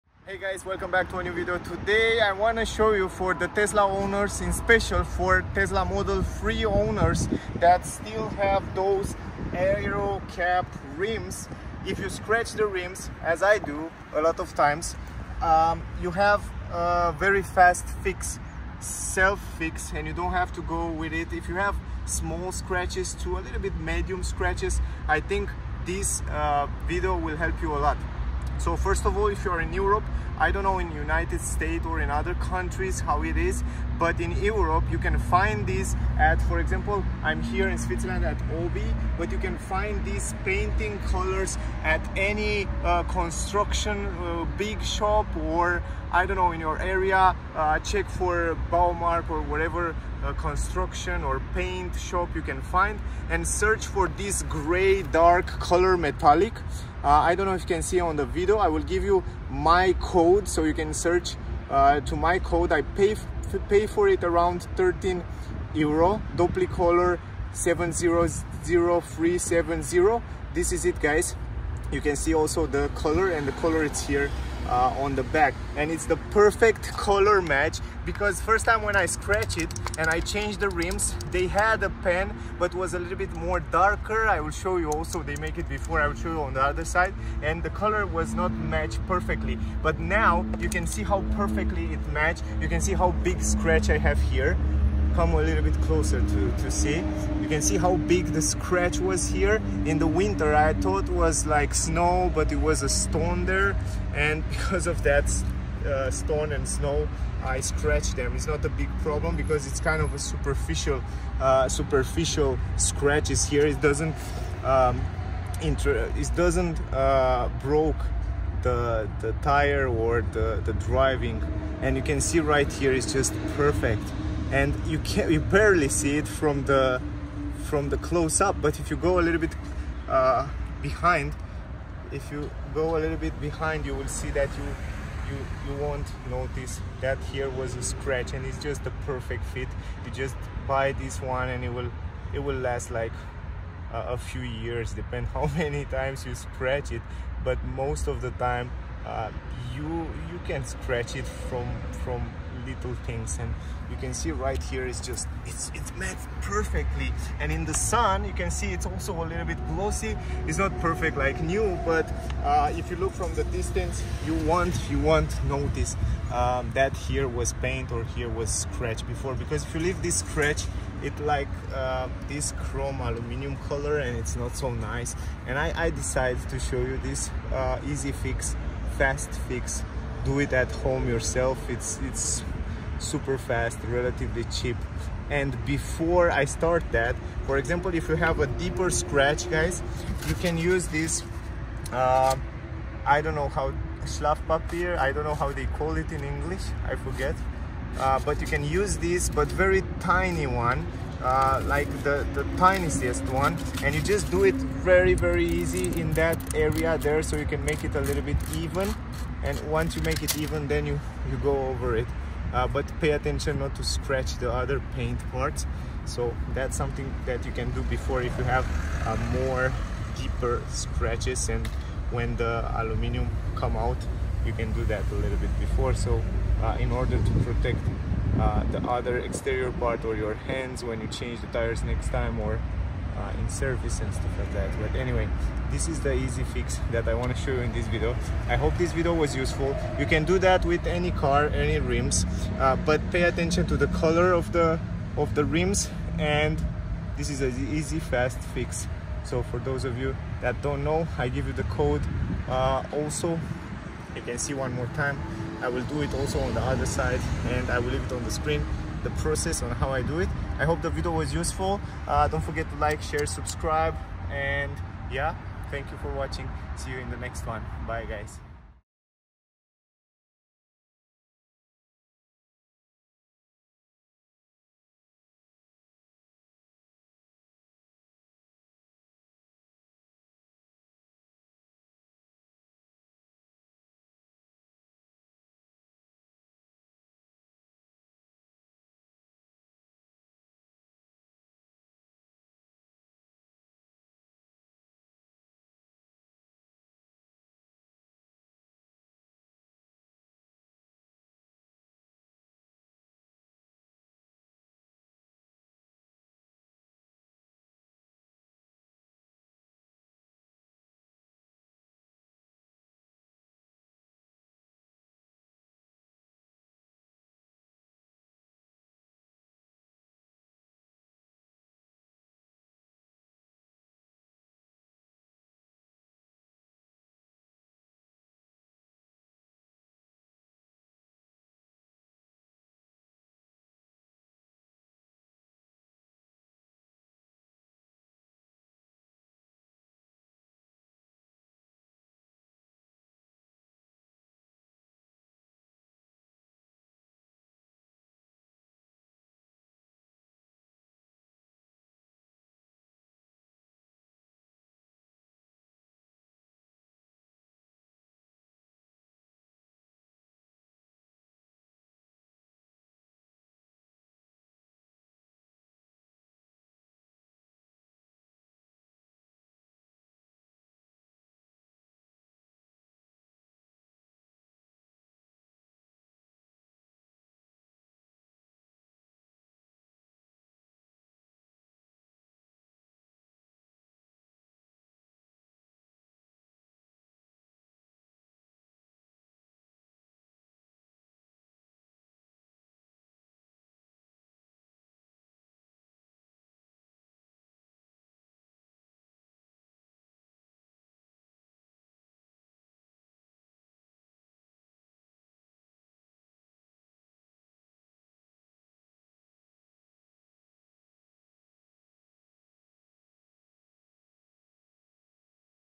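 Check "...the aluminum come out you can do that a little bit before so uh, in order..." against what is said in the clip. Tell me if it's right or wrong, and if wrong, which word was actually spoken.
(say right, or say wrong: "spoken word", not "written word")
right.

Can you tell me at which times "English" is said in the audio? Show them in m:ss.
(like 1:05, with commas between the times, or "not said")
3:16.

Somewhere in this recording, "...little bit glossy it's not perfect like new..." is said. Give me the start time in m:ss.
2:39.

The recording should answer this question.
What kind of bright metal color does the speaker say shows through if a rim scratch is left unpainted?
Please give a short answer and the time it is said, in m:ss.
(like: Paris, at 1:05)
chrome aluminum, at 2:52.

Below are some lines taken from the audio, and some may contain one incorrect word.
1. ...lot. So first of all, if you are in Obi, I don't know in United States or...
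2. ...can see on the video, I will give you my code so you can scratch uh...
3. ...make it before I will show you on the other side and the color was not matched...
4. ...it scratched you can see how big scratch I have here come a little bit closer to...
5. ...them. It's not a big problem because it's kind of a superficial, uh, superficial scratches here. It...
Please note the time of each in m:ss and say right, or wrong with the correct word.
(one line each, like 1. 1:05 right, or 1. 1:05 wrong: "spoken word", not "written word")
1. 0:27 wrong: "Europe", not "Obi"
2. 0:57 wrong: "search", not "scratch"
3. 1:25 right
4. 1:31 wrong: "matched", not "scratched"
5. 1:48 right.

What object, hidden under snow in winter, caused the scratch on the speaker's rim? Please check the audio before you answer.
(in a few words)
a stone.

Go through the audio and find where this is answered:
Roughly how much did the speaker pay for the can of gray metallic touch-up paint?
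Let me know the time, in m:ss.
1:04.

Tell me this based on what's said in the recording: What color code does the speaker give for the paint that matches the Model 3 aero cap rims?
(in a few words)
700370.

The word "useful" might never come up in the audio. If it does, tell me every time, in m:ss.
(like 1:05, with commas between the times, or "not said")
3:59, 4:21.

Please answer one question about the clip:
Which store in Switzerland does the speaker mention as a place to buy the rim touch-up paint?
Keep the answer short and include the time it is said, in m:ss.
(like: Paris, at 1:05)
Obi, at 0:38.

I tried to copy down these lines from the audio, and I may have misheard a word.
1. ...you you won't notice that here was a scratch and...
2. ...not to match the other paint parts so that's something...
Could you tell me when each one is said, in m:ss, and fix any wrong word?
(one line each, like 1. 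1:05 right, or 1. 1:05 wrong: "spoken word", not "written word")
1. 2:15 right
2. 3:33 wrong: "scratch", not "match".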